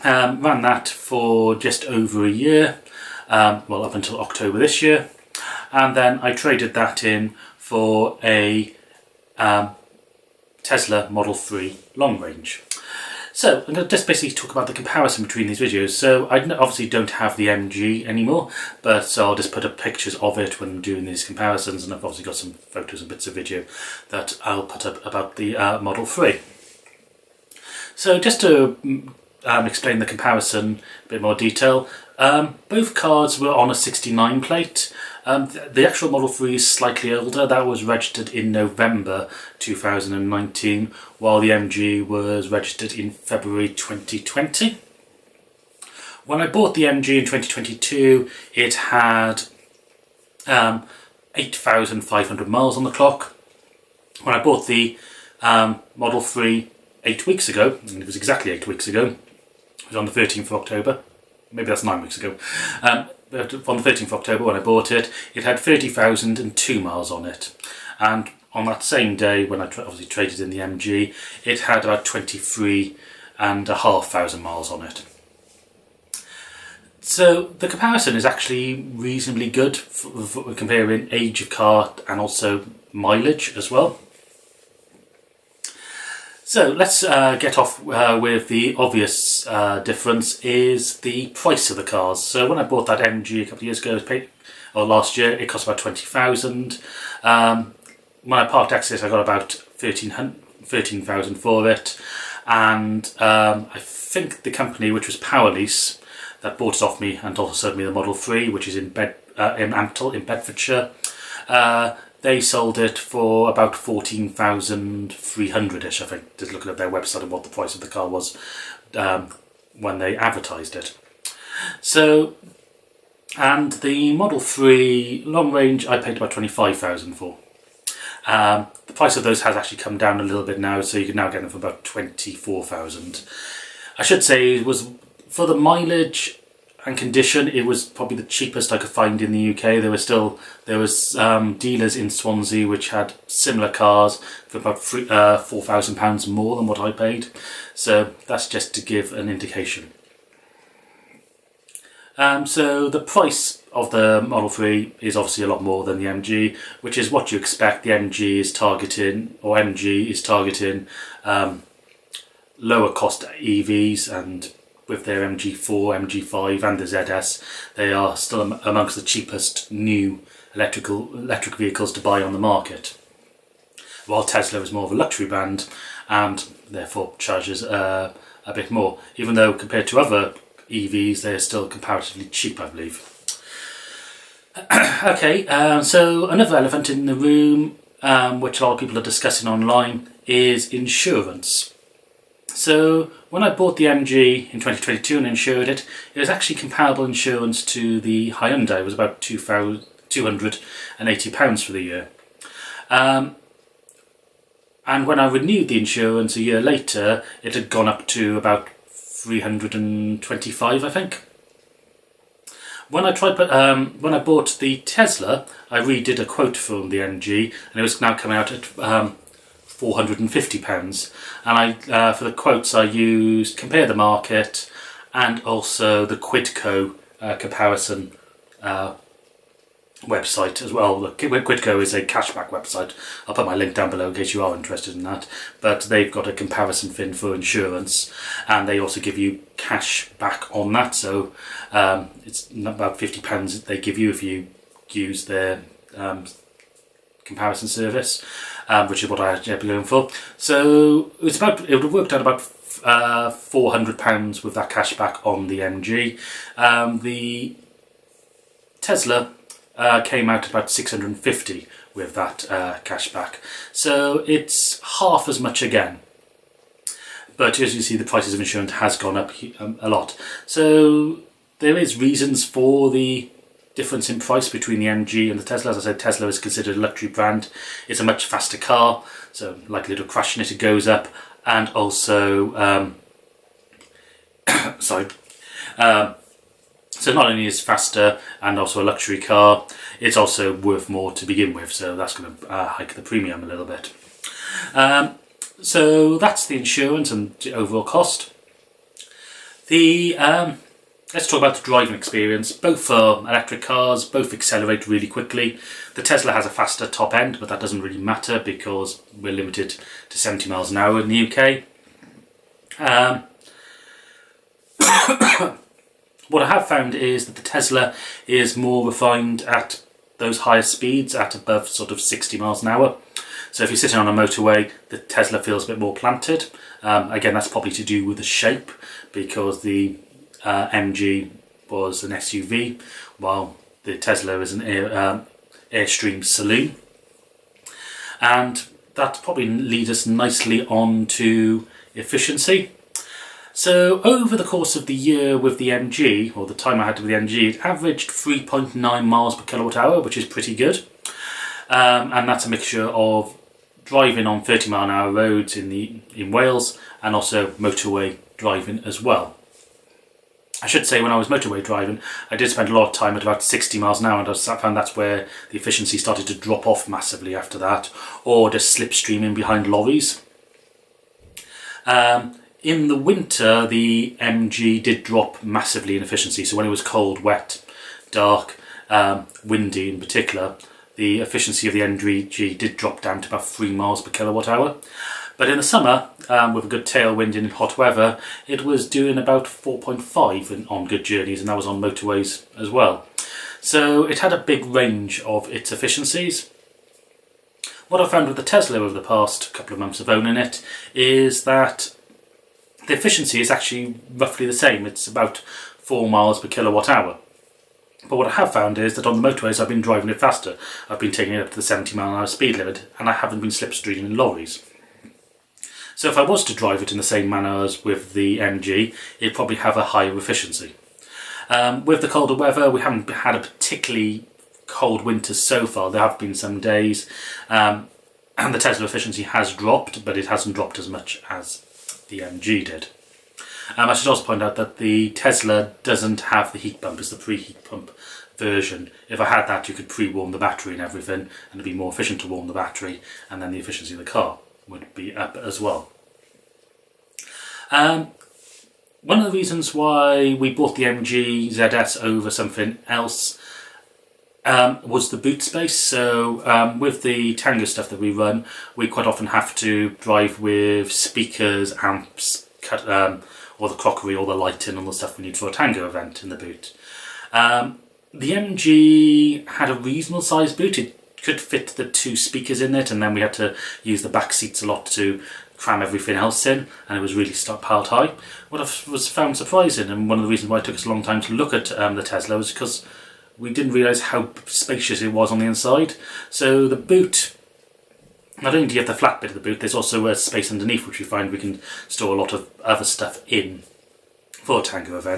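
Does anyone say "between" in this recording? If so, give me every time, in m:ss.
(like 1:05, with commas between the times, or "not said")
0:15, 4:34.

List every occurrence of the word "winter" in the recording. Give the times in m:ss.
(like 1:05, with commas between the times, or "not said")
6:12, 7:05.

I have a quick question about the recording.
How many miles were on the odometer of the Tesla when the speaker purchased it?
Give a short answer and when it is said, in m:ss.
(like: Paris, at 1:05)
30,002, at 1:05.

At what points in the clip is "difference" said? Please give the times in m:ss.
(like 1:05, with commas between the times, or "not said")
1:29, 4:33.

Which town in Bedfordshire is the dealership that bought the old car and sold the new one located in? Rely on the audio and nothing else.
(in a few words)
Ampthill.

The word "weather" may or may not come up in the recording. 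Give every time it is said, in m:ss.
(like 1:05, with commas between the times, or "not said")
6:27, 7:02.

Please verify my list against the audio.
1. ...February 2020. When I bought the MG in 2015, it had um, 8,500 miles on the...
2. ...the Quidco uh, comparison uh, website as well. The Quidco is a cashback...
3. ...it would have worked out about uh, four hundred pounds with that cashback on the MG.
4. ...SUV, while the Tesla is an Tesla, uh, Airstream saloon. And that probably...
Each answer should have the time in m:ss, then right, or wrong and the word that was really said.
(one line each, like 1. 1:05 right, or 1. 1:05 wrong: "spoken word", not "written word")
1. 0:43 wrong: "2022", not "2015"
2. 3:46 right
3. 4:11 right
4. 5:32 wrong: "Air", not "Tesla".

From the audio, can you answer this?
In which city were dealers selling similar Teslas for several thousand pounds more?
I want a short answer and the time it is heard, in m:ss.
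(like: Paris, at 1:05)
Swansea, at 2:22.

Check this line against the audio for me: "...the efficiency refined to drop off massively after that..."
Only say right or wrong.
wrong.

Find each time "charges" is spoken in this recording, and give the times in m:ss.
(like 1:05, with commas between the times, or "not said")
2:57.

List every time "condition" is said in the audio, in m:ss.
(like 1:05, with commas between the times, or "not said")
2:16.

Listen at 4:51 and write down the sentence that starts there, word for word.
So that's going to uh, hike the premium a little bit.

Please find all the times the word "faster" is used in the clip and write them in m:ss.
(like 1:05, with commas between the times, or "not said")
4:38, 4:47, 5:06, 6:50.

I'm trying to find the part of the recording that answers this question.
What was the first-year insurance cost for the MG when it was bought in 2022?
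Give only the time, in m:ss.
3:19.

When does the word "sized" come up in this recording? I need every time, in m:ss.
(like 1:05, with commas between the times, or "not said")
7:50.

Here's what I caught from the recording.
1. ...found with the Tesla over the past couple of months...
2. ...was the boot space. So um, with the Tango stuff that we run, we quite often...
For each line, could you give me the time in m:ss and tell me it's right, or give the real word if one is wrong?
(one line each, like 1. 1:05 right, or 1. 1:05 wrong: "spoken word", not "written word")
1. 6:38 right
2. 7:34 right.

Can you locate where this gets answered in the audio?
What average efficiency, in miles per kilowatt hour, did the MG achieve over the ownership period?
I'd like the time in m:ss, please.
5:48.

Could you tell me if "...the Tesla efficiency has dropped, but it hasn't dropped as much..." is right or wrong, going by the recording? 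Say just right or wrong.
right.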